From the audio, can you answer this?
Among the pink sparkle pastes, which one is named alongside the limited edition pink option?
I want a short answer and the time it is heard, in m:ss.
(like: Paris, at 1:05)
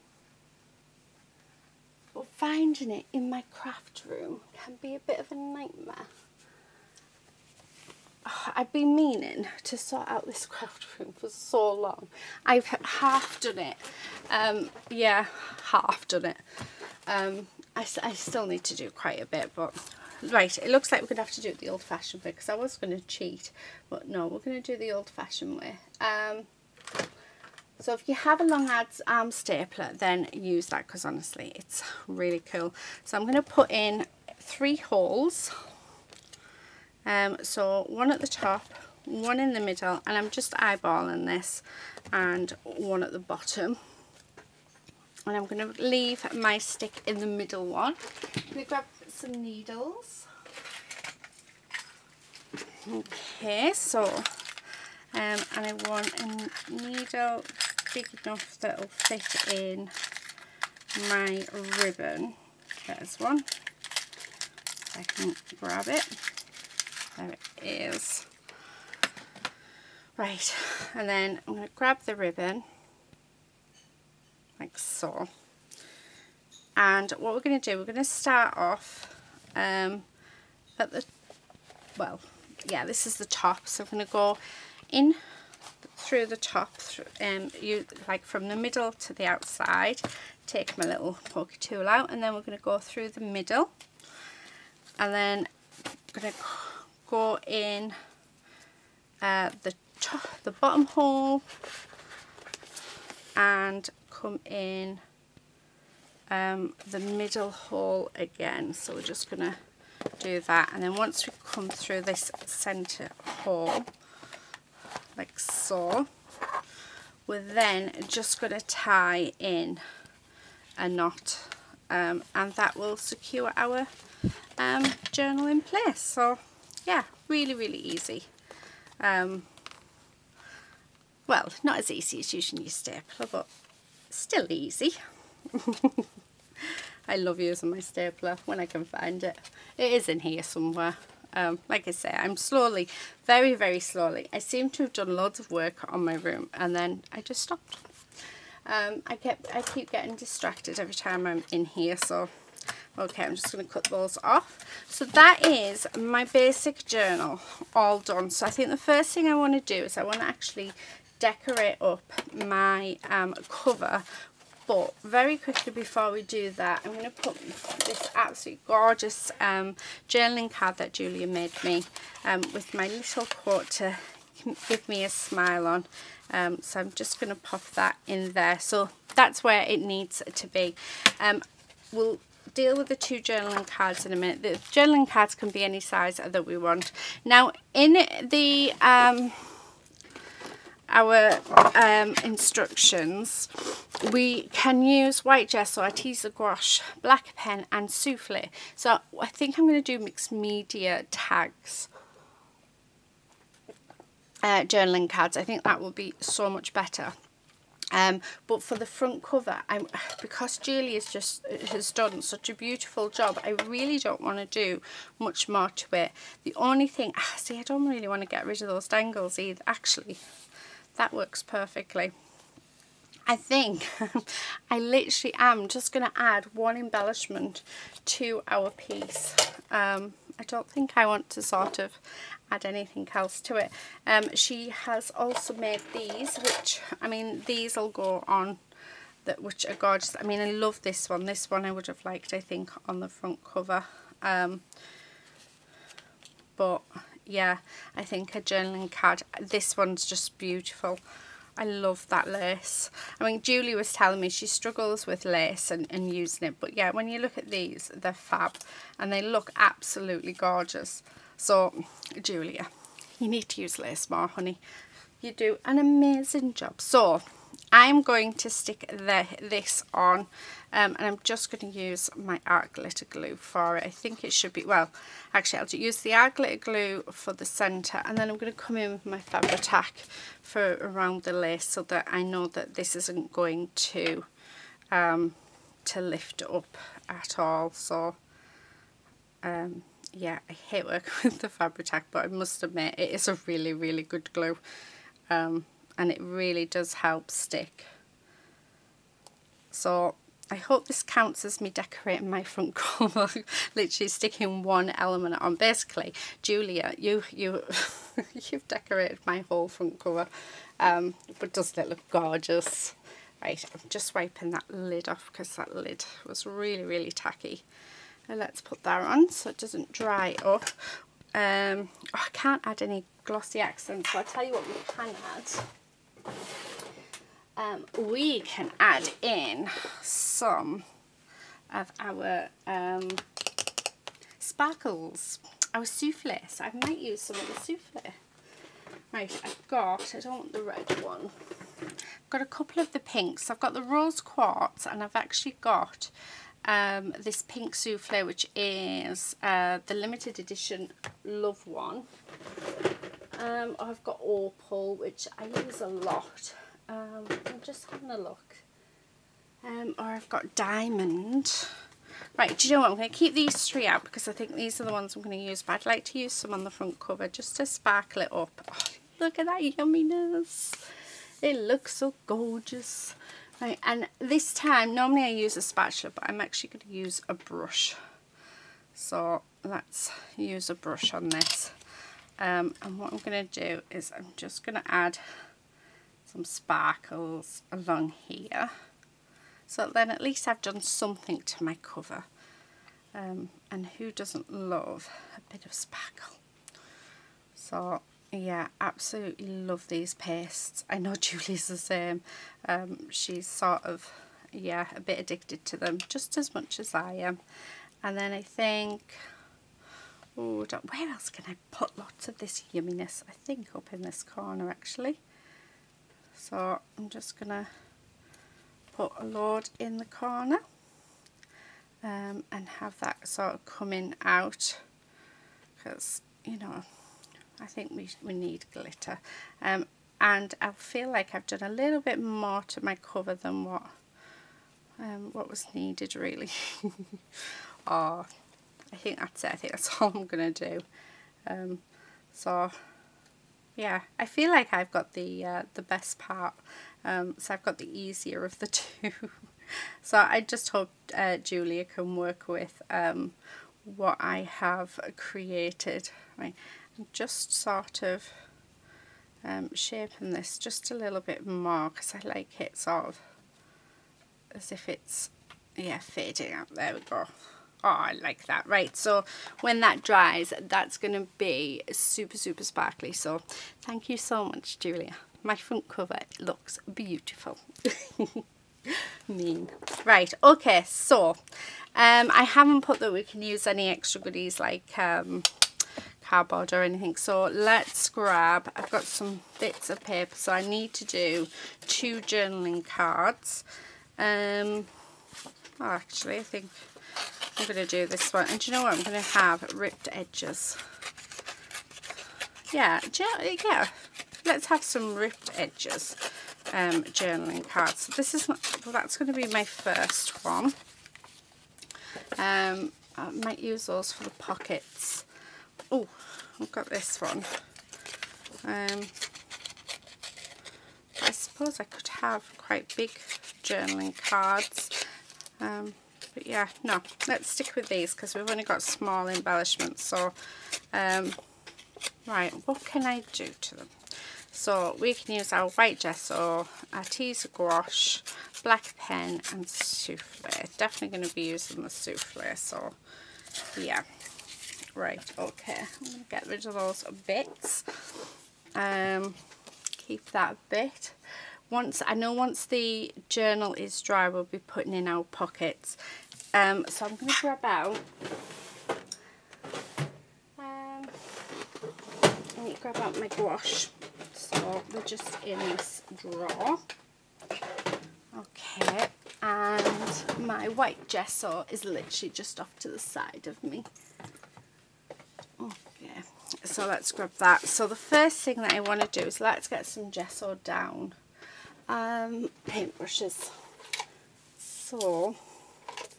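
Rose quartz, at 5:43.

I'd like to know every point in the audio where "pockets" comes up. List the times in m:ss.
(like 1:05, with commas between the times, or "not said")
8:34, 9:15.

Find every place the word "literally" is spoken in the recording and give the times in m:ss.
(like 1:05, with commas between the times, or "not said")
3:44, 5:03, 9:31.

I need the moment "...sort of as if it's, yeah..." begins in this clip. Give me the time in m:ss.
7:42.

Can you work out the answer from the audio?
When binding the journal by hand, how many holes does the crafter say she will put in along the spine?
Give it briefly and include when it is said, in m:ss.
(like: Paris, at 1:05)
3, at 0:34.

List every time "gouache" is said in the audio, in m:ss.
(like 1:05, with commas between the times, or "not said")
3:16, 8:57, 9:23.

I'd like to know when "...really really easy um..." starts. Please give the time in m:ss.
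2:07.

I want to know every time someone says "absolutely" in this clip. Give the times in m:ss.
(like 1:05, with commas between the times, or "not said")
2:48, 4:19, 6:38.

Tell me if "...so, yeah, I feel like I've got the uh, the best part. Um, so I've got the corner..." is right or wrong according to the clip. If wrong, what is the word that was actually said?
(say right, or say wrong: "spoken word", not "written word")
wrong: "easier", not "corner".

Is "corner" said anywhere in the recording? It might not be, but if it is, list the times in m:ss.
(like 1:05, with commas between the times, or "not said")
6:54, 7:00.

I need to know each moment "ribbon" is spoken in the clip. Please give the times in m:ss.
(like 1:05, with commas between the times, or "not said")
1:01, 1:12.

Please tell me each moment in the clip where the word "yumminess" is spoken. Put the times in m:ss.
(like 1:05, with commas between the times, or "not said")
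6:09, 6:52.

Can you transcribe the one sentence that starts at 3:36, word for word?
The only thing, ah, see, I don't really want to get rid of those dangles either.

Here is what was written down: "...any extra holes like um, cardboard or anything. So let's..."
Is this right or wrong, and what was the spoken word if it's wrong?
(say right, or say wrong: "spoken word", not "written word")
wrong: "goodies", not "holes".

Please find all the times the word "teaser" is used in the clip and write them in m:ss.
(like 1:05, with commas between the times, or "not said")
3:15, 8:57.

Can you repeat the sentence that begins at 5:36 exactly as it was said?
So I might use some of the souffle.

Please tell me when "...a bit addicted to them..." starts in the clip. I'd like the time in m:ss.
6:44.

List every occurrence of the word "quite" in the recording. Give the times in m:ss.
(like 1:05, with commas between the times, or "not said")
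0:18, 8:42.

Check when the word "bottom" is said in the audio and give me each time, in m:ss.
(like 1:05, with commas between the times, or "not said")
0:43, 1:40.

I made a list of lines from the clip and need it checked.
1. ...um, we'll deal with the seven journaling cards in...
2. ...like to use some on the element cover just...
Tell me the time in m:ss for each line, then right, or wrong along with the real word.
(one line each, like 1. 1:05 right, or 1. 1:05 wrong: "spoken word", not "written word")
1. 3:01 wrong: "two", not "seven"
2. 6:05 wrong: "front", not "element".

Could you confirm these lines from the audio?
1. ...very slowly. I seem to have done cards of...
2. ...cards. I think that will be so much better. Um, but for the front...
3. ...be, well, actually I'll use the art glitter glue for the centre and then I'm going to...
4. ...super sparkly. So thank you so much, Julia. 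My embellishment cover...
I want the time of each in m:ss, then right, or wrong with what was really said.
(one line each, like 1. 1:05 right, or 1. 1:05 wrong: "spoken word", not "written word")
1. 2:23 wrong: "loads", not "cards"
2. 3:25 right
3. 4:34 right
4. 7:52 wrong: "front", not "embellishment".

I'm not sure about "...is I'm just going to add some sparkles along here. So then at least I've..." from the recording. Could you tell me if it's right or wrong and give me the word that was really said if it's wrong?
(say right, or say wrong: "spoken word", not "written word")
right.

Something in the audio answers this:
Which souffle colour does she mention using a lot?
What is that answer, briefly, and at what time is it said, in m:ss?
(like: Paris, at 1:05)
Opal, at 5:54.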